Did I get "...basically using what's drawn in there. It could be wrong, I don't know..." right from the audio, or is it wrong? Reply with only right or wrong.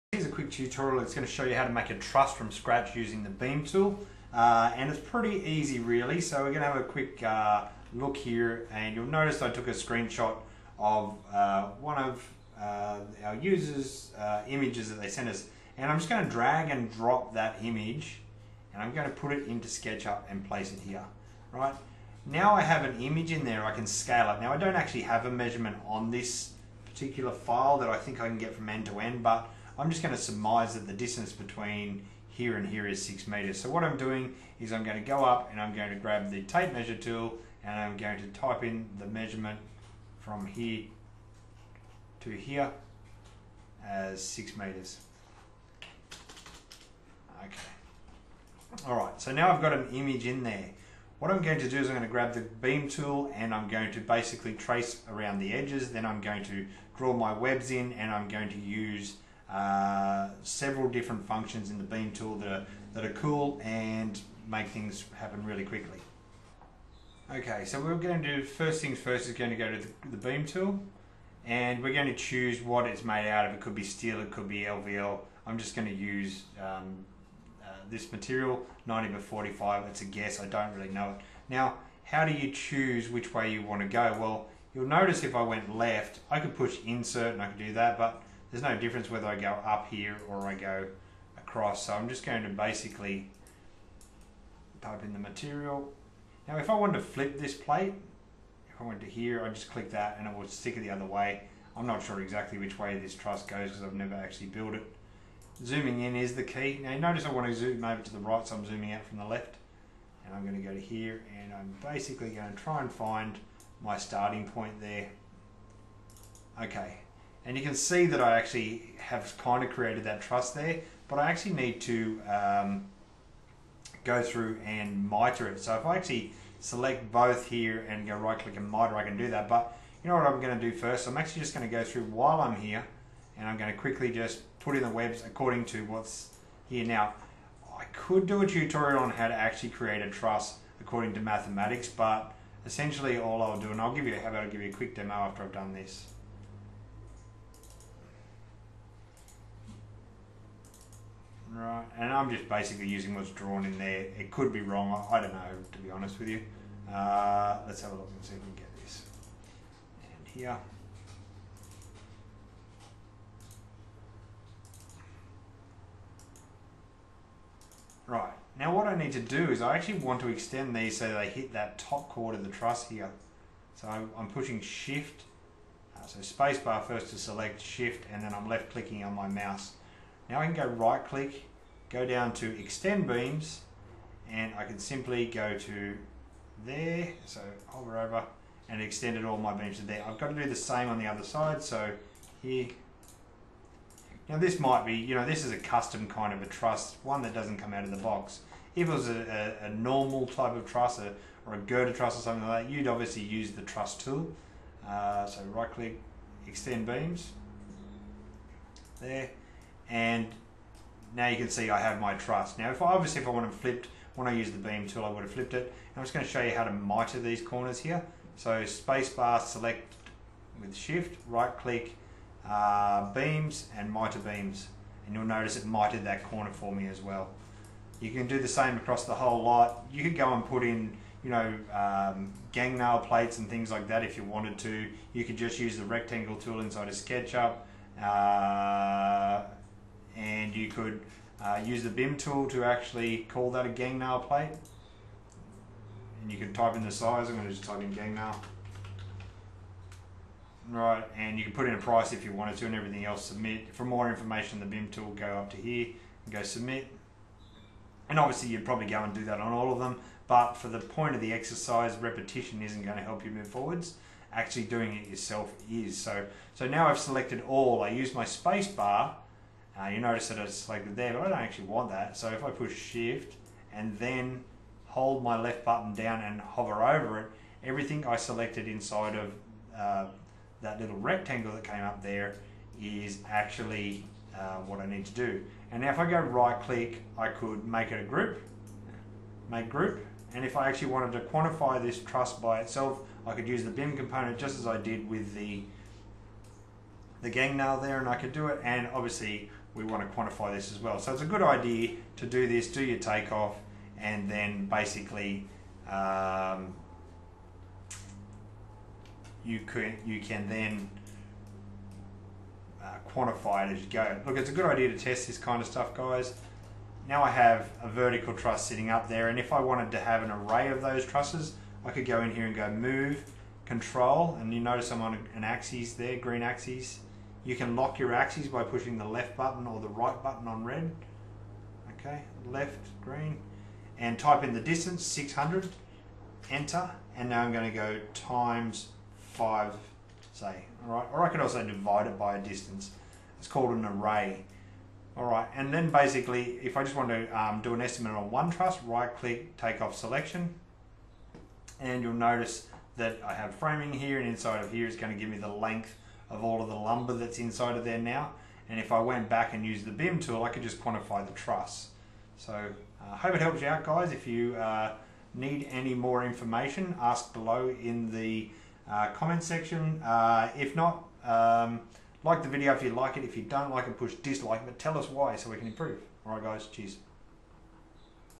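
right.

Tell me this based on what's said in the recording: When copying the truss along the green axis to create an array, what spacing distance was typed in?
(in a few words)
600.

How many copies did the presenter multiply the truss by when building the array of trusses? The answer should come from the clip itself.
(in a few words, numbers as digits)
5.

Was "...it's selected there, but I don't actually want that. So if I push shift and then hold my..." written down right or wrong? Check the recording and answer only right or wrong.
right.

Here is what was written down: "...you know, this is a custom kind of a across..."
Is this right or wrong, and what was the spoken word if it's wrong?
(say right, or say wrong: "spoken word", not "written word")
wrong: "truss", not "across".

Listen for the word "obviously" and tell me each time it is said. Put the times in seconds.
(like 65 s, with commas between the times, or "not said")
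202 s, 212 s, 258 s, 298 s.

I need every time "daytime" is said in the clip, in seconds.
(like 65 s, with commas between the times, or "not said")
not said.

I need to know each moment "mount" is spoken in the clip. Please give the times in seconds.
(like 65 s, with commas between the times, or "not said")
not said.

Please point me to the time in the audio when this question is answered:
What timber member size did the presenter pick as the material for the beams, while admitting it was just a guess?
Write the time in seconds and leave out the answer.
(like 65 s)
78 s.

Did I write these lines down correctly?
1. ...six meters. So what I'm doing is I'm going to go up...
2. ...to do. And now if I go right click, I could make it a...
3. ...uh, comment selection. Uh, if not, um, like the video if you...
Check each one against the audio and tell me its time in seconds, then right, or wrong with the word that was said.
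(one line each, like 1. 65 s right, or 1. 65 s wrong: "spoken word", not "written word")
1. 33 s right
2. 285 s right
3. 368 s wrong: "section", not "selection".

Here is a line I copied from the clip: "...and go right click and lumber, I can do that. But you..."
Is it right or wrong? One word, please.
wrong.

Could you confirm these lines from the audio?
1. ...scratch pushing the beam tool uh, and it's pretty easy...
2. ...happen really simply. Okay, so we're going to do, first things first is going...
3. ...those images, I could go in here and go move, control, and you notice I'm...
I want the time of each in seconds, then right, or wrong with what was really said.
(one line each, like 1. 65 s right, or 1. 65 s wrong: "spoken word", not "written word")
1. 2 s wrong: "using", not "pushing"
2. 65 s wrong: "quickly", not "simply"
3. 320 s wrong: "trusses", not "images".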